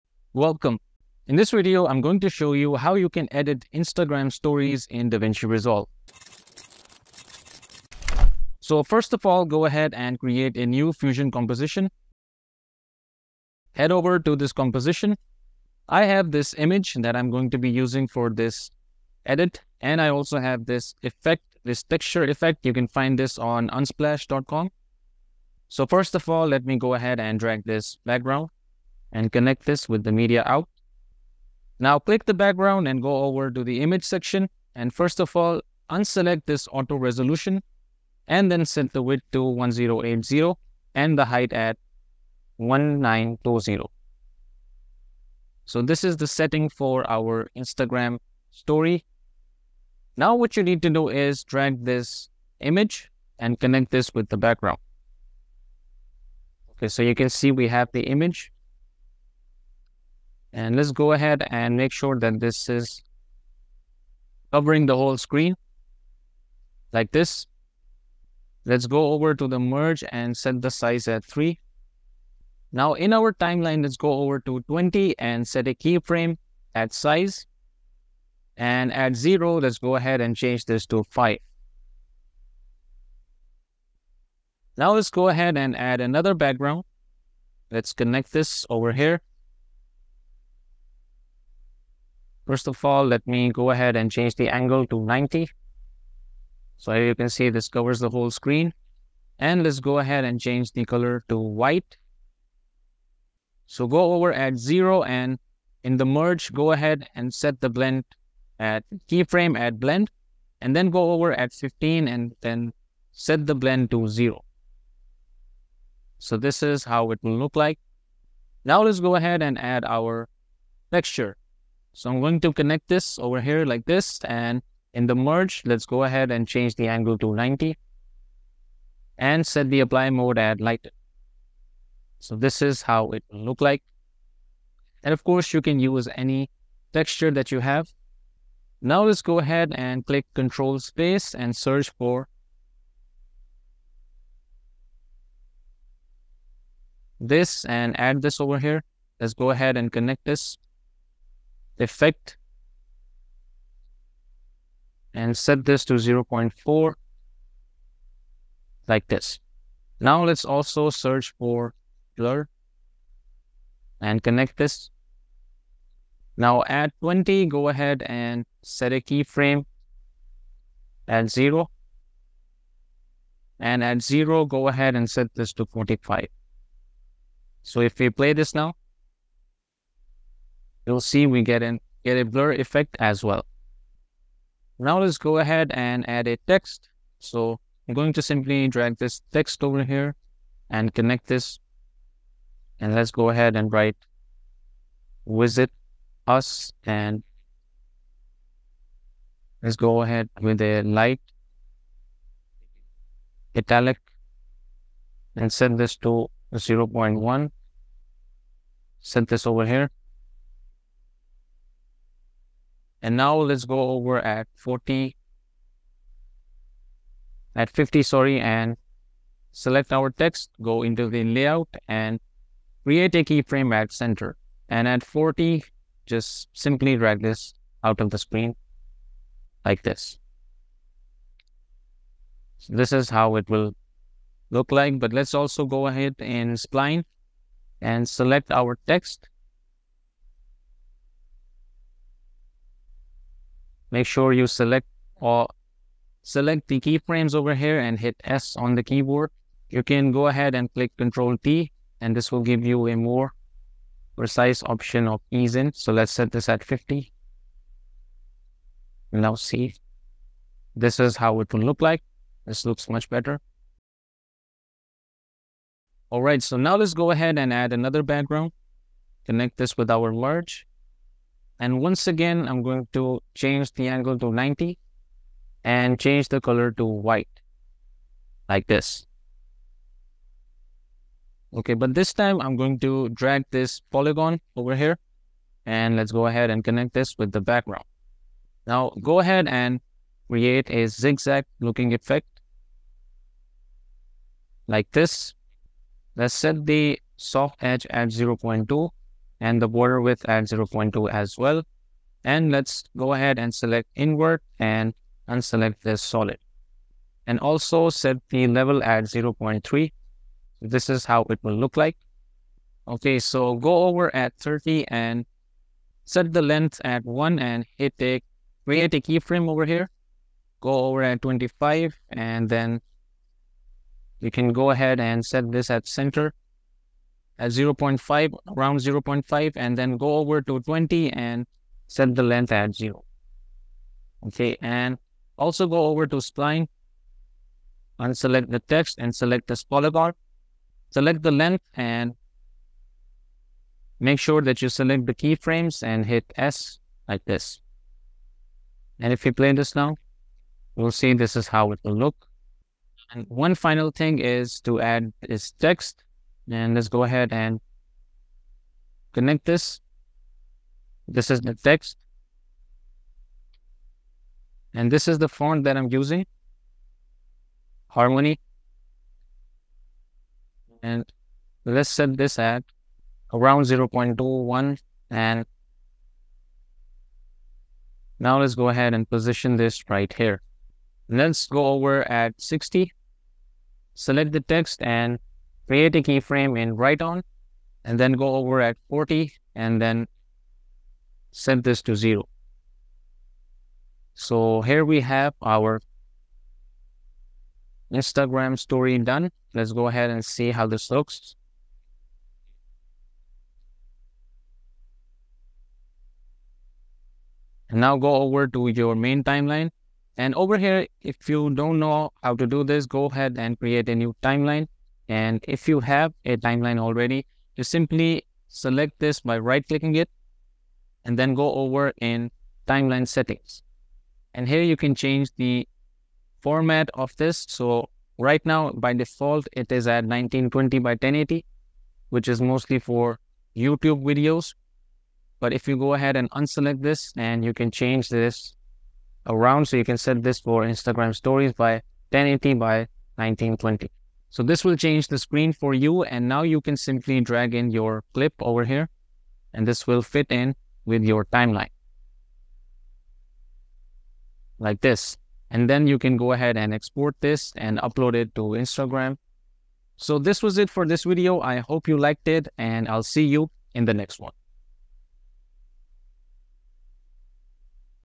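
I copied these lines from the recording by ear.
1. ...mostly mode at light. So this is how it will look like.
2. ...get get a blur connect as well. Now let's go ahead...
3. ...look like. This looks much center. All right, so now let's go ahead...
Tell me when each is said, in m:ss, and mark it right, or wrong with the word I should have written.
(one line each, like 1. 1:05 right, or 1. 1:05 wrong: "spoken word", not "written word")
1. 2:09 wrong: "apply", not "mostly"
2. 3:01 wrong: "effect", not "connect"
3. 4:21 wrong: "better", not "center".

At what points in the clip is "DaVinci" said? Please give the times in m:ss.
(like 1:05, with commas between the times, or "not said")
0:05.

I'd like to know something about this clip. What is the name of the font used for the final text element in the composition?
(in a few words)
Harmony.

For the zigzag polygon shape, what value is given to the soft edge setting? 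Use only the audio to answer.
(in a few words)
0.2.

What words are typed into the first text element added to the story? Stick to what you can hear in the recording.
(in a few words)
visit us.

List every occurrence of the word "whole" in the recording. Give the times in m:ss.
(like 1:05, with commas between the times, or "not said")
1:04, 1:38.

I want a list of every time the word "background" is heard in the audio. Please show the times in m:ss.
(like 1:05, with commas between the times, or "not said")
0:28, 0:32, 0:54, 1:26, 4:28, 4:47.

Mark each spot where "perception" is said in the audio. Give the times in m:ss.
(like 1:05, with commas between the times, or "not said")
not said.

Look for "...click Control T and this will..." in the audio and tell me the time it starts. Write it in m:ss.
4:10.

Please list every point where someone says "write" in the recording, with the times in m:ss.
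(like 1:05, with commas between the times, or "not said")
3:13, 6:26.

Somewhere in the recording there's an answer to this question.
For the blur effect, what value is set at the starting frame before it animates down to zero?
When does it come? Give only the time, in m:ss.
2:55.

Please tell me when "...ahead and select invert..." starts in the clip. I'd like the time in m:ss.
5:03.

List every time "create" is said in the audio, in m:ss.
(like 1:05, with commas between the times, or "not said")
0:10, 3:42, 4:50, 5:18, 6:25, 6:53.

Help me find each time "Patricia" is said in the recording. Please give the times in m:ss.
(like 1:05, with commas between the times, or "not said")
not said.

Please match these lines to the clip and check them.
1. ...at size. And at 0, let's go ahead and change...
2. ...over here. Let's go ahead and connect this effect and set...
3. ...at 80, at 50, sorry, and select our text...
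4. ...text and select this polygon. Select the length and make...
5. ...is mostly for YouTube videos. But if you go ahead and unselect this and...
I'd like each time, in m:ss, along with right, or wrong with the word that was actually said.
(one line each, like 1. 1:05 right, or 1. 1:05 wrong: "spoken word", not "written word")
1. 1:16 right
2. 2:28 right
3. 3:34 wrong: "40", not "80"
4. 5:38 right
5. 7:12 right.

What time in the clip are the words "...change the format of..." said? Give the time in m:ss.
7:04.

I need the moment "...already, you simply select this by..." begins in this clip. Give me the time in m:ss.
6:56.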